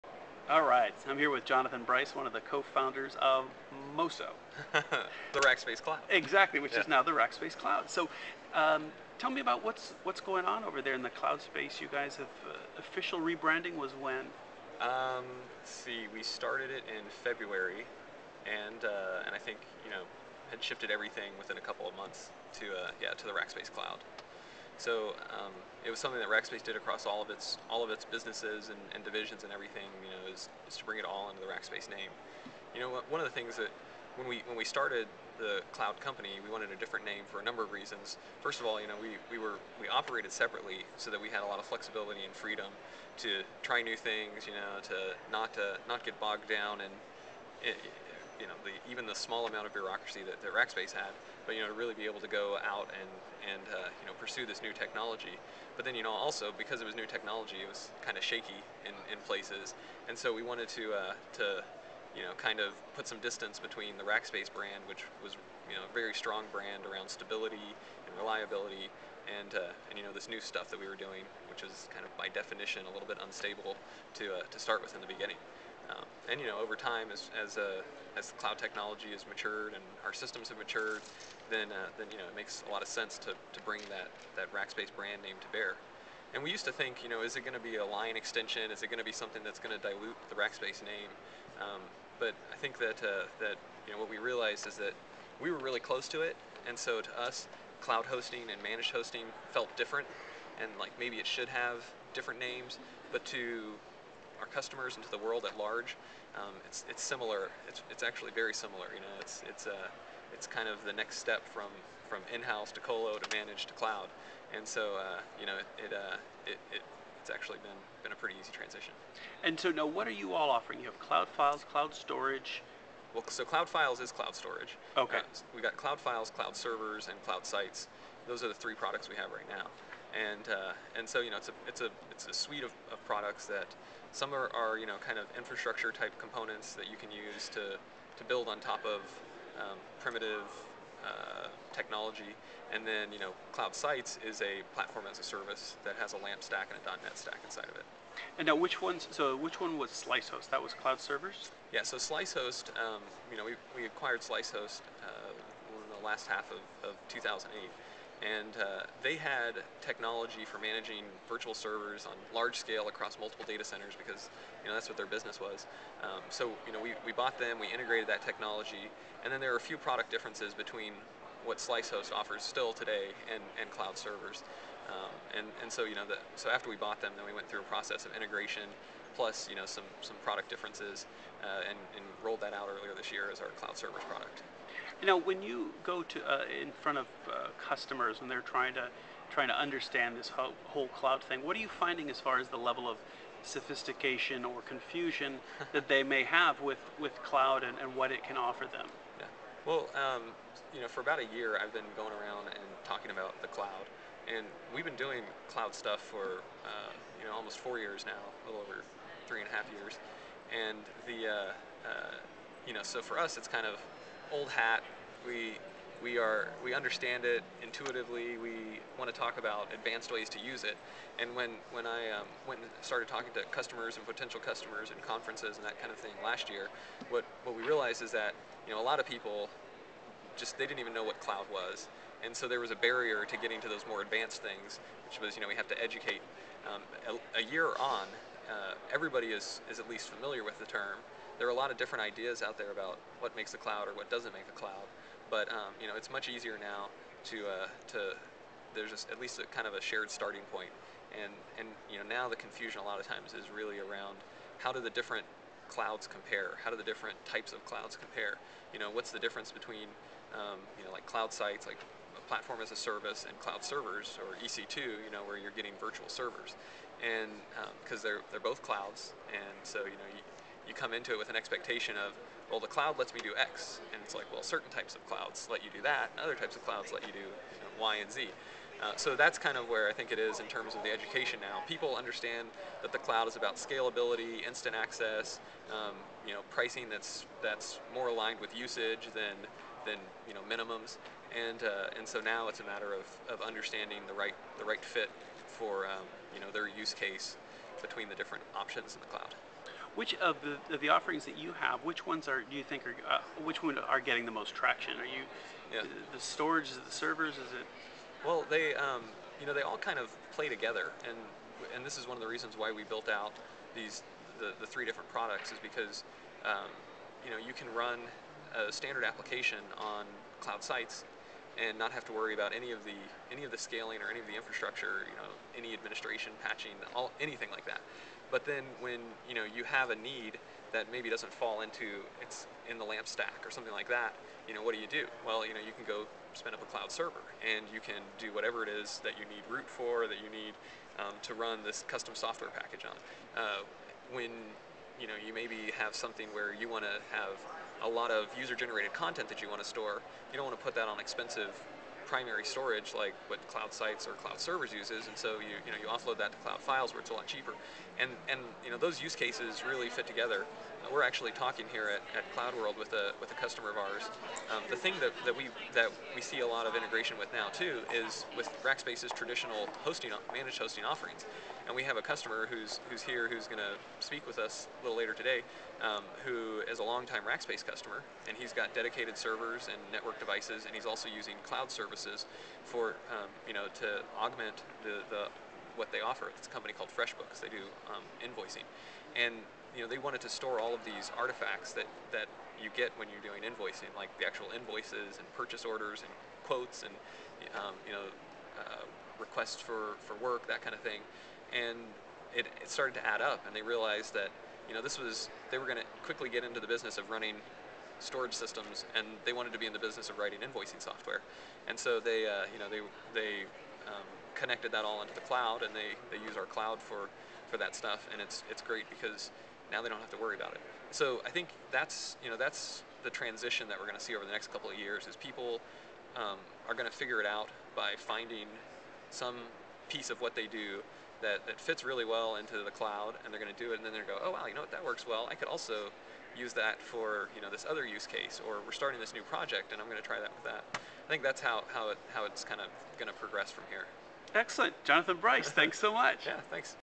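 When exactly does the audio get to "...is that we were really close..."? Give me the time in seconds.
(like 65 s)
94 s.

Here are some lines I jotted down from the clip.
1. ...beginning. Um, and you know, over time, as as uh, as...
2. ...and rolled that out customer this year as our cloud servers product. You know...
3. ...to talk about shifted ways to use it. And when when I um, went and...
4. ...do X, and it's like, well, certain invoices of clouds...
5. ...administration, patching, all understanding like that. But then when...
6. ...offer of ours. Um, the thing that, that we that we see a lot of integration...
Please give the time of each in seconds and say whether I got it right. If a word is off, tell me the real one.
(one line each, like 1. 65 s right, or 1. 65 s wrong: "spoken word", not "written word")
1. 75 s right
2. 181 s wrong: "earlier", not "customer"
3. 219 s wrong: "advanced", not "shifted"
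4. 273 s wrong: "types", not "invoices"
5. 325 s wrong: "anything", not "understanding"
6. 363 s wrong: "customer", not "offer".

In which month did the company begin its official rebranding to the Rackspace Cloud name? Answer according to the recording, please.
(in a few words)
February.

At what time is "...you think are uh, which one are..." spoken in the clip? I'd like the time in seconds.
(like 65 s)
302 s.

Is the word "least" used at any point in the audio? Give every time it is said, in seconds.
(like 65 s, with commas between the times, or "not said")
239 s, 249 s.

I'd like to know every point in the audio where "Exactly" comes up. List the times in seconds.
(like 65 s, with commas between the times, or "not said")
6 s.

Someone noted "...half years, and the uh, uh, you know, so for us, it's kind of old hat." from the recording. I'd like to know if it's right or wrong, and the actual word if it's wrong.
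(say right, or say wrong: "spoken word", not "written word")
right.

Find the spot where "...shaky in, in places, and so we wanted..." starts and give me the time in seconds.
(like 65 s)
58 s.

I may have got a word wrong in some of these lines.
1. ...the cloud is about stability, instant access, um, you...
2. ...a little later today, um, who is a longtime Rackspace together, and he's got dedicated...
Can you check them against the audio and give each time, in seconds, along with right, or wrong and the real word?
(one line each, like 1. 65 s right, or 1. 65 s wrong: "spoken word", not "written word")
1. 282 s wrong: "scalability", not "stability"
2. 374 s wrong: "customer", not "together".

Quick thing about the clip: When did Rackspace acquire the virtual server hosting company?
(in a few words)
Last half of 2008.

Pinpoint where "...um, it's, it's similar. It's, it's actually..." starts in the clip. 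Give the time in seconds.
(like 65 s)
106 s.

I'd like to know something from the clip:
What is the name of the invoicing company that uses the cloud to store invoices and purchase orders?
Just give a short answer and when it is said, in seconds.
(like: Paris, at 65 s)
FreshBooks, at 386 s.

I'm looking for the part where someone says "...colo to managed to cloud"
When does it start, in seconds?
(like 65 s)
112 s.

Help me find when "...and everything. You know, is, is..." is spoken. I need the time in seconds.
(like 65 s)
29 s.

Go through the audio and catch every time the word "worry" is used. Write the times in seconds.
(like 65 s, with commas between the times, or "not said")
322 s, 420 s.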